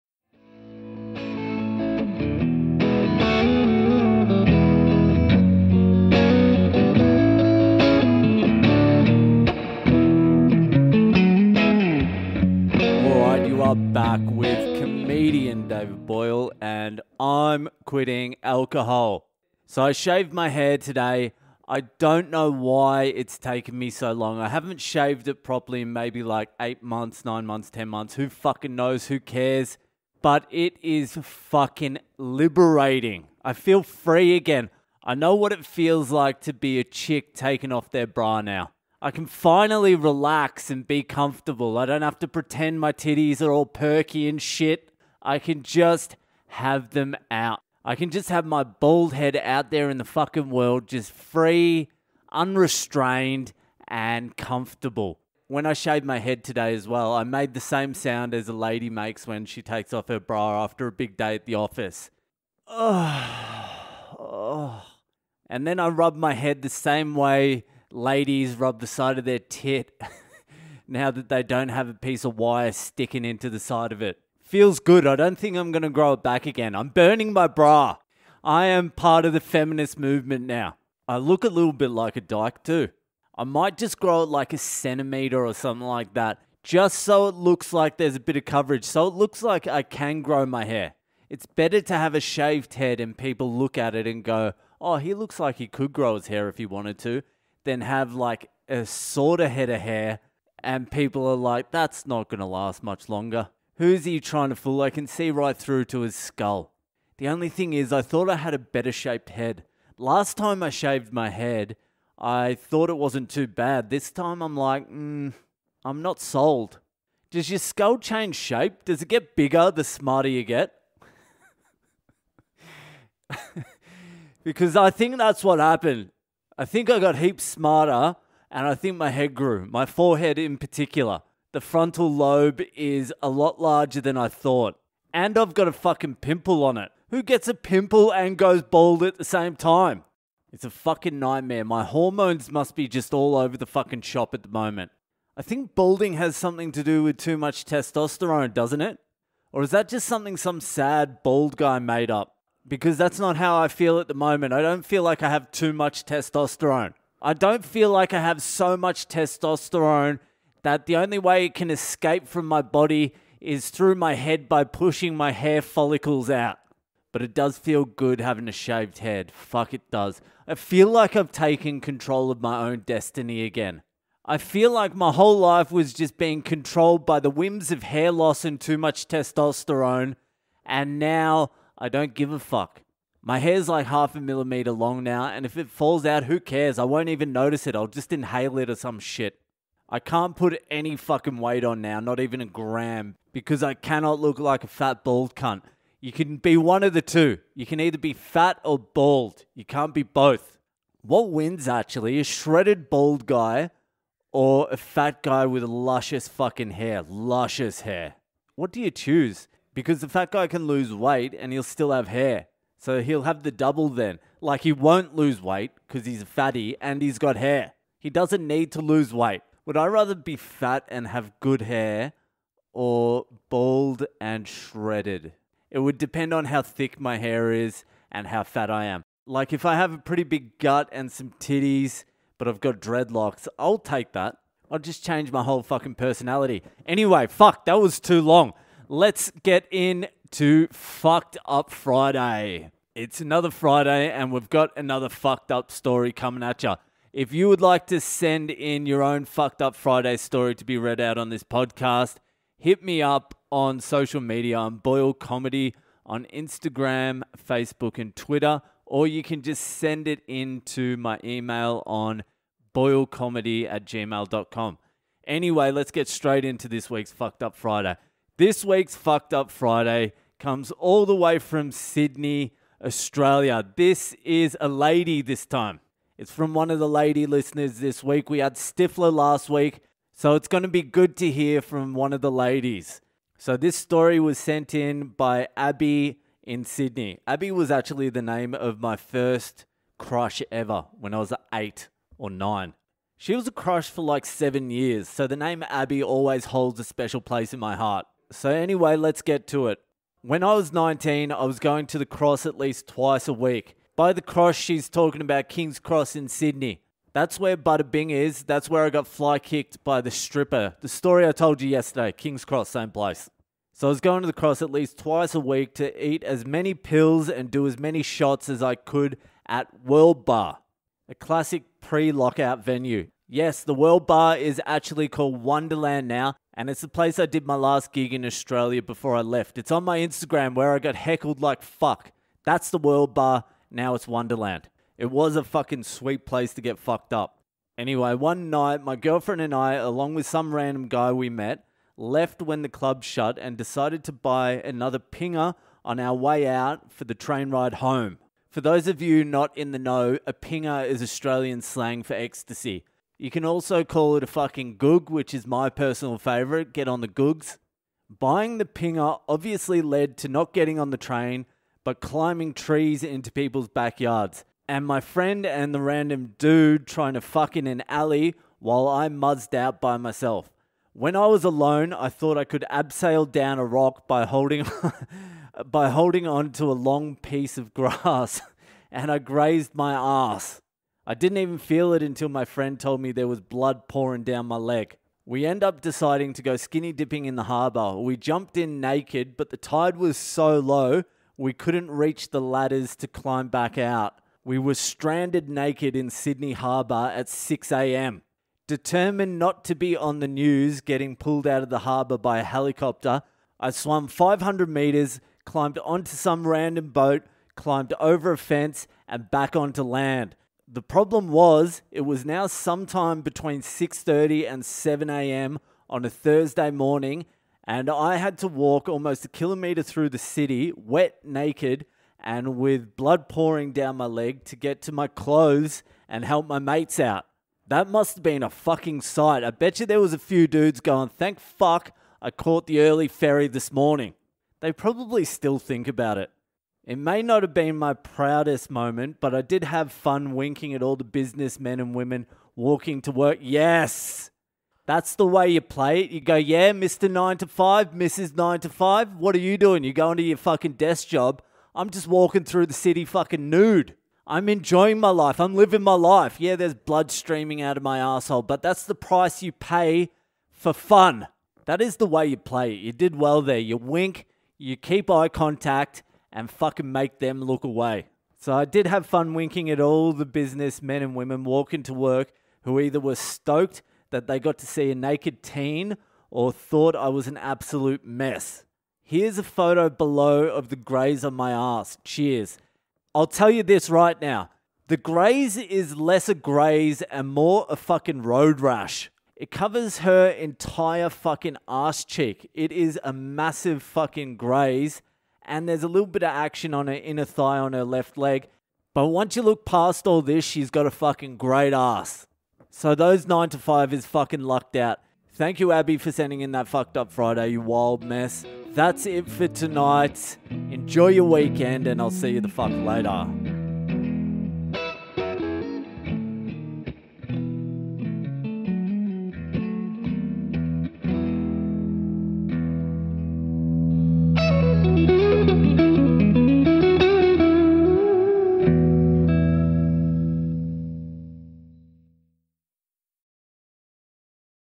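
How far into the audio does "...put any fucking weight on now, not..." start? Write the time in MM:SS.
03:10.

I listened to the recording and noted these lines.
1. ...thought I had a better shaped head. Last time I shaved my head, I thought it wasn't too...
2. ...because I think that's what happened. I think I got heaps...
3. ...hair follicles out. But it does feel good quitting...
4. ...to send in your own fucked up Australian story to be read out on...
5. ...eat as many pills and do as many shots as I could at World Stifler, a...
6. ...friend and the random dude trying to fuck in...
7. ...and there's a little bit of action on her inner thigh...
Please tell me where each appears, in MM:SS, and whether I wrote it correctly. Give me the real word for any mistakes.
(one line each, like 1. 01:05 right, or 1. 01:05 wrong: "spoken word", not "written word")
1. 01:48 right
2. 02:04 right
3. 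02:45 wrong: "having", not "quitting"
4. 04:07 wrong: "Friday", not "Australian"
5. 05:16 wrong: "Bar", not "Stifler"
6. 06:05 right
7. 08:15 right.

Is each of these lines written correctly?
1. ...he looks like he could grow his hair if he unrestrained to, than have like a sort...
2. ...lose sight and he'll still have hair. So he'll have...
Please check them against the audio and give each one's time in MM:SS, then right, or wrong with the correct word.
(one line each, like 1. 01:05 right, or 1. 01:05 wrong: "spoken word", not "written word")
1. 01:34 wrong: "wanted", not "unrestrained"
2. 03:30 wrong: "weight", not "sight".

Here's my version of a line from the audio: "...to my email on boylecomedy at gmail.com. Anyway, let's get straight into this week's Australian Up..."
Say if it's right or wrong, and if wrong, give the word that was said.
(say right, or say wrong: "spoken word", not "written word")
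wrong: "Fucked", not "Australian".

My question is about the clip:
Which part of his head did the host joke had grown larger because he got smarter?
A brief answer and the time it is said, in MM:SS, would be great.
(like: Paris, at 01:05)
frontal lobe, at 02:11.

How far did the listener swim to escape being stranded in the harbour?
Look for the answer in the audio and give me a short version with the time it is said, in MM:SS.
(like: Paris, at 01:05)
500 metres, at 06:44.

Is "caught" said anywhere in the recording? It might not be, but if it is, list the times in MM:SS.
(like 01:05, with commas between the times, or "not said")
07:12.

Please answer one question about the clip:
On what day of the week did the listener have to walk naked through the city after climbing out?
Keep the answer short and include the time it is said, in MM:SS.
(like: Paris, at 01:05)
Thursday, at 06:56.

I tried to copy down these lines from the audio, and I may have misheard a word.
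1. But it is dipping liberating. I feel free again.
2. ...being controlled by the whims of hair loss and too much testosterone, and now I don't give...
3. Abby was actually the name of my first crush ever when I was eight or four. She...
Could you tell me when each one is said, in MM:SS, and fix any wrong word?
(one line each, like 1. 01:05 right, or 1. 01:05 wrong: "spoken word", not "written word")
1. 00:30 wrong: "fucking", not "dipping"
2. 02:56 right
3. 04:47 wrong: "nine", not "four".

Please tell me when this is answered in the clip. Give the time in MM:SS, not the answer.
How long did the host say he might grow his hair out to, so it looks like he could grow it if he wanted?
01:24.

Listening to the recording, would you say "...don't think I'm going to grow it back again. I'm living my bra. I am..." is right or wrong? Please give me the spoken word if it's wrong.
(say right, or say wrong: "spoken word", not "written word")
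wrong: "burning", not "living".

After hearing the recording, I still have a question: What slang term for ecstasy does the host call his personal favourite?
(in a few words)
goog.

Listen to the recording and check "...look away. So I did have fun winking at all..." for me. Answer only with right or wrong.
right.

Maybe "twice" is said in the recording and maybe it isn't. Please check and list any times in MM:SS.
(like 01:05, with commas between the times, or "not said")
05:02, 05:14.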